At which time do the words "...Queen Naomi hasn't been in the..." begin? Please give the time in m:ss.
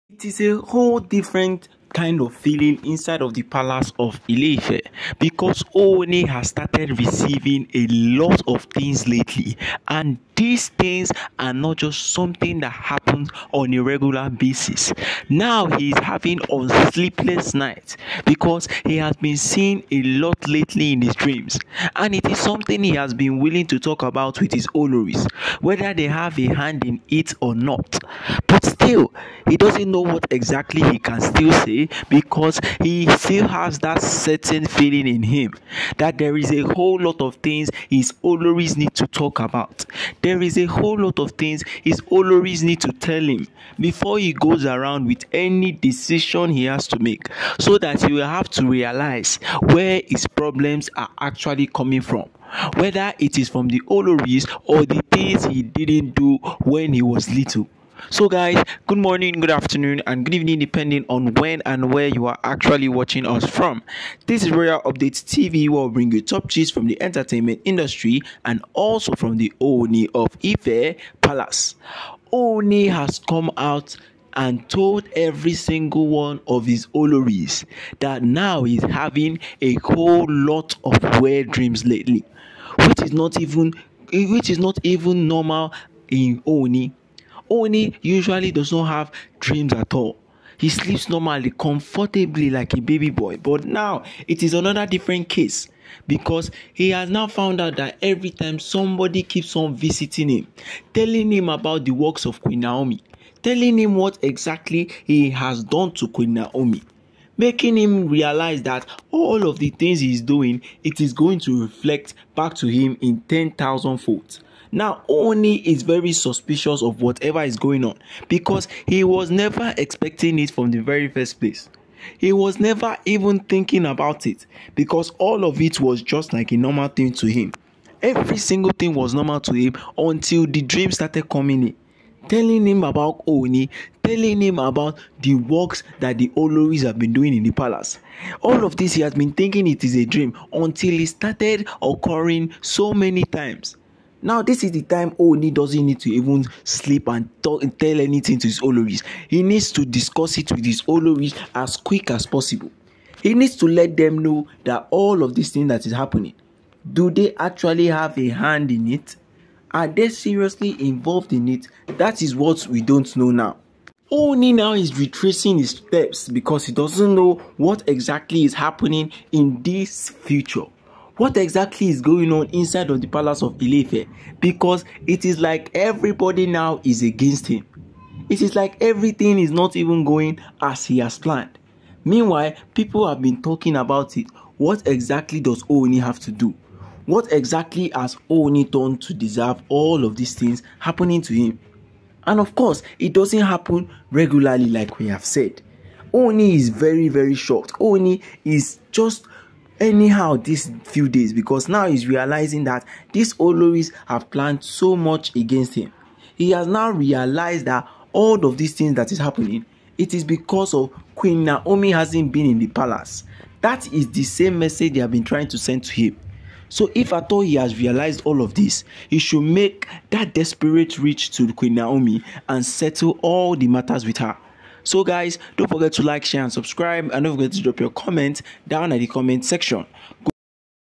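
3:31.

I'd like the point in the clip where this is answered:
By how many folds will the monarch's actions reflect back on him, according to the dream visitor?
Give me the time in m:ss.
1:53.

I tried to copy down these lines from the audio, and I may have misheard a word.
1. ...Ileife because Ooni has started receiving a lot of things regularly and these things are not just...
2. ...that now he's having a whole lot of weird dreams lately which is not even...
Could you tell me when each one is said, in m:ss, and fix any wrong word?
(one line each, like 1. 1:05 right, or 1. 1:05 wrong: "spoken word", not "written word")
1. 0:04 wrong: "lately", not "regularly"
2. 1:17 right.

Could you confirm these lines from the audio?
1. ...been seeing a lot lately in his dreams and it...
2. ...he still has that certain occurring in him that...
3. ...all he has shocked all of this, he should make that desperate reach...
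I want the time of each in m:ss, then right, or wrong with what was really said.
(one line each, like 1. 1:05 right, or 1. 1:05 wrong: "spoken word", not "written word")
1. 0:19 right
2. 0:32 wrong: "feeling", not "occurring"
3. 3:37 wrong: "realized", not "shocked".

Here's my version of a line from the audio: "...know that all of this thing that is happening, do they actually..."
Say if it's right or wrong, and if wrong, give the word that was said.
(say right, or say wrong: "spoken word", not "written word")
right.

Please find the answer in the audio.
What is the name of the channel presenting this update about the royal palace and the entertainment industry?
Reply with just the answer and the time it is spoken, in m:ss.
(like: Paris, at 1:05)
Royal Updates TV, at 1:04.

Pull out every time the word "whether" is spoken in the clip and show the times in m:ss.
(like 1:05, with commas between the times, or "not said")
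0:25, 0:52.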